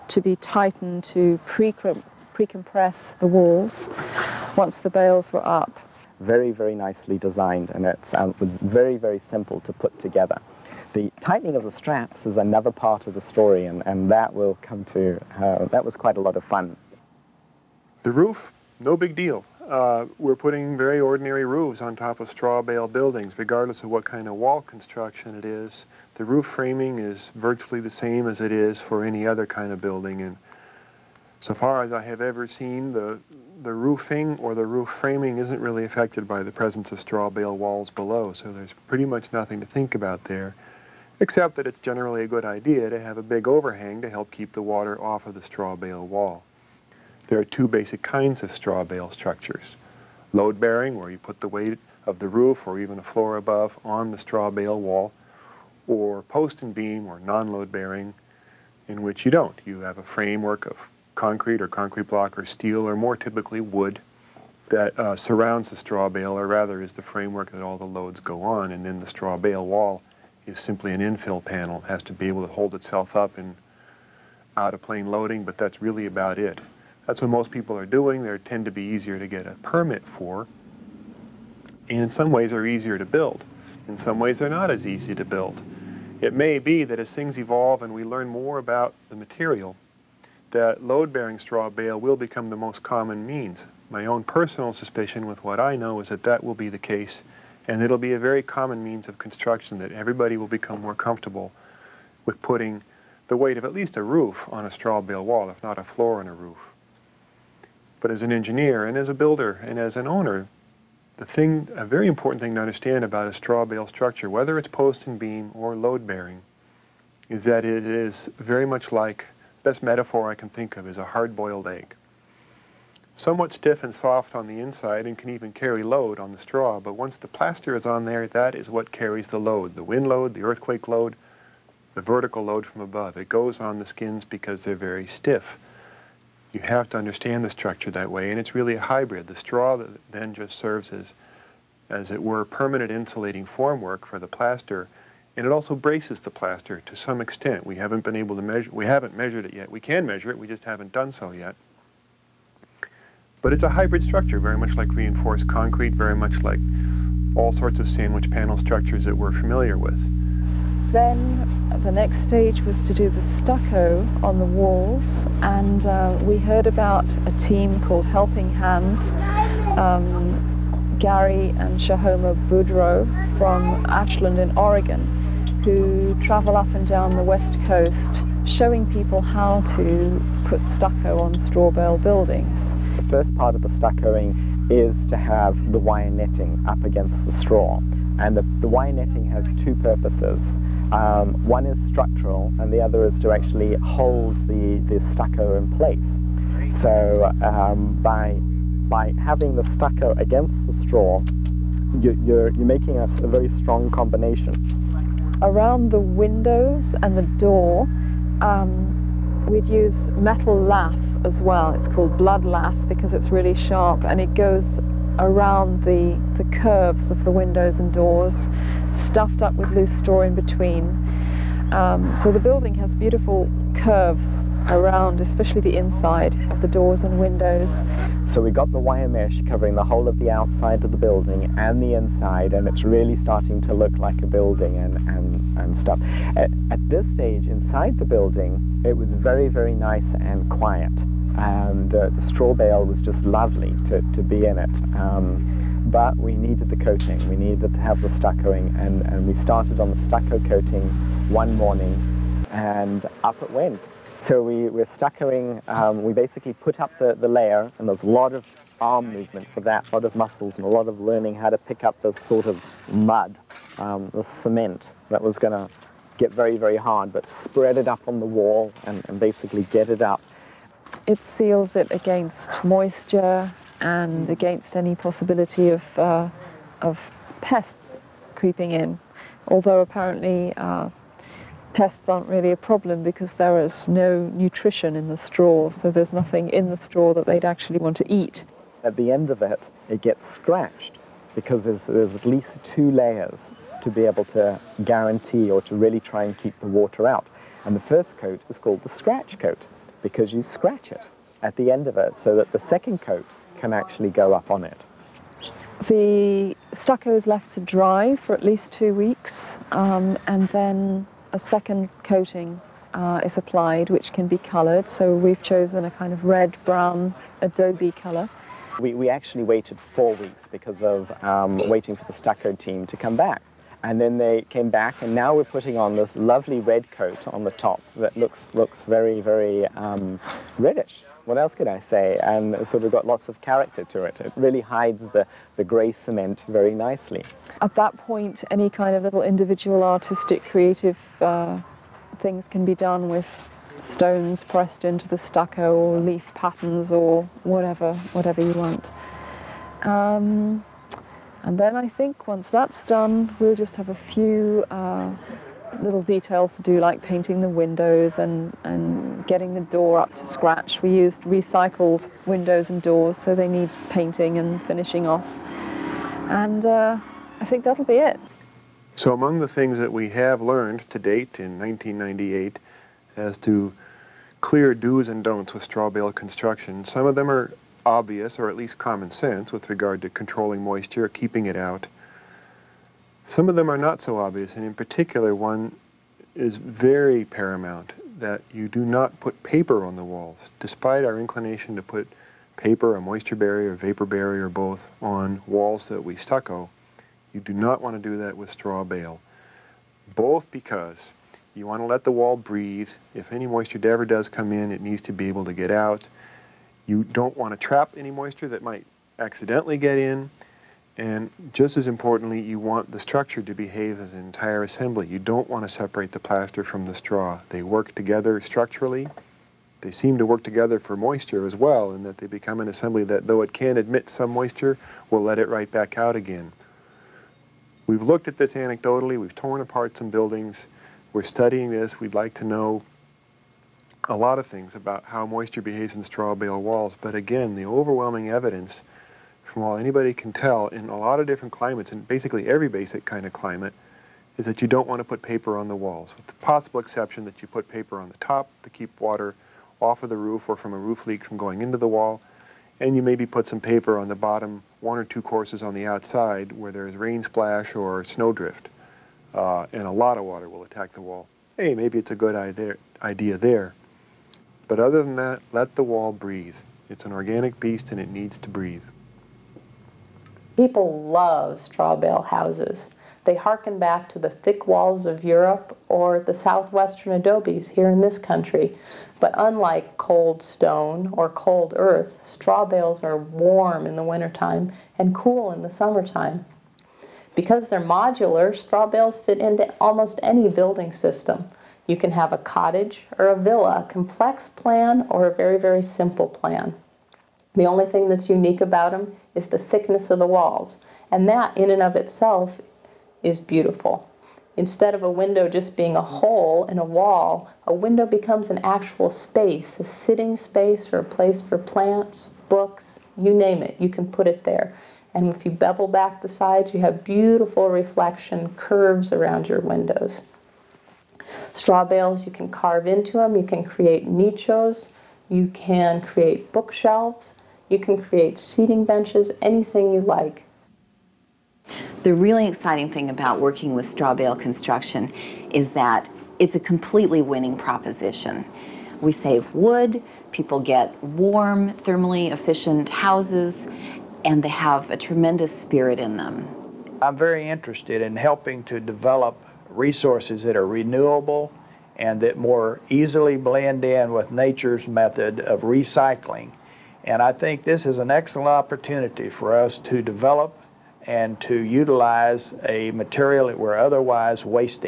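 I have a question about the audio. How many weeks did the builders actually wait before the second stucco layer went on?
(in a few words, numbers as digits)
4.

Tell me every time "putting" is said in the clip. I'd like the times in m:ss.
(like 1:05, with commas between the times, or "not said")
0:20, 1:42, 5:25.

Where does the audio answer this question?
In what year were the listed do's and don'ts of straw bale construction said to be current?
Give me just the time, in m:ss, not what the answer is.
6:11.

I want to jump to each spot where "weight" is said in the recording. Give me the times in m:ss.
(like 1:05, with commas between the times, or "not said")
0:51, 1:43.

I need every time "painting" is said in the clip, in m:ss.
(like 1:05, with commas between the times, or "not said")
5:57, 6:03.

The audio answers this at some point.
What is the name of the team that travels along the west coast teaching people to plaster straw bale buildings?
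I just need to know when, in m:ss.
2:48.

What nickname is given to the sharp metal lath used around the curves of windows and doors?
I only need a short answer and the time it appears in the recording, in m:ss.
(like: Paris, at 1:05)
Blood lath, at 3:32.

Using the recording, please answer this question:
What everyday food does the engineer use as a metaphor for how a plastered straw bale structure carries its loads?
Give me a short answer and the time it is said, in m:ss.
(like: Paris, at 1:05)
Hard-boiled egg, at 2:01.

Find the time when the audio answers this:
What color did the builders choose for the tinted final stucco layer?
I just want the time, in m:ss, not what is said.
5:16.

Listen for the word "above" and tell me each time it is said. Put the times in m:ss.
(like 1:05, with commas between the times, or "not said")
0:53, 2:12.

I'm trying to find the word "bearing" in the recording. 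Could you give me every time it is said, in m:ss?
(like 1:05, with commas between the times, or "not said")
0:50, 0:57, 1:30, 1:56.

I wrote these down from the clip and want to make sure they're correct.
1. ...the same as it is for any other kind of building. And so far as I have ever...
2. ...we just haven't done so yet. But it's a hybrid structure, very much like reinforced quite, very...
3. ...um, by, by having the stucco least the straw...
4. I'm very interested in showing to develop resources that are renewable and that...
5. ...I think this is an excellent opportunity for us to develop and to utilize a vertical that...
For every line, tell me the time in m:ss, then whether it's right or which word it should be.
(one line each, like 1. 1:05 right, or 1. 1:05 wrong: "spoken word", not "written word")
1. 0:27 right
2. 2:30 wrong: "concrete", not "quite"
3. 3:17 wrong: "against", not "least"
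4. 9:07 wrong: "helping", not "showing"
5. 9:17 wrong: "material", not "vertical".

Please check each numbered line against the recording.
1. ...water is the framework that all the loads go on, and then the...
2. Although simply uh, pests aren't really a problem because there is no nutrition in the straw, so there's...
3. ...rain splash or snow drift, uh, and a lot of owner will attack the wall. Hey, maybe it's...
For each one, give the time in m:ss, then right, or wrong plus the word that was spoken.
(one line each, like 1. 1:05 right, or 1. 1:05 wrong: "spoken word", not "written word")
1. 1:06 wrong: "rather", not "water"
2. 4:39 wrong: "apparently", not "simply"
3. 7:36 wrong: "water", not "owner".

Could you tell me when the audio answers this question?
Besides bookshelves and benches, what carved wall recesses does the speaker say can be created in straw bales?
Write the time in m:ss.
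8:44.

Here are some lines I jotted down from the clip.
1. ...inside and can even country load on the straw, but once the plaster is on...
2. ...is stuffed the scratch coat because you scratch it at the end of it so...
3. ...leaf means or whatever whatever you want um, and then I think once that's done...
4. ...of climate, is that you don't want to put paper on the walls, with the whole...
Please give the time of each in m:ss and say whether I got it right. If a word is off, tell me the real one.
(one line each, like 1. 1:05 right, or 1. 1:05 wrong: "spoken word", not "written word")
1. 2:04 wrong: "carry", not "country"
2. 4:58 wrong: "called", not "stuffed"
3. 5:46 wrong: "patterns", not "means"
4. 7:23 wrong: "possible", not "whole".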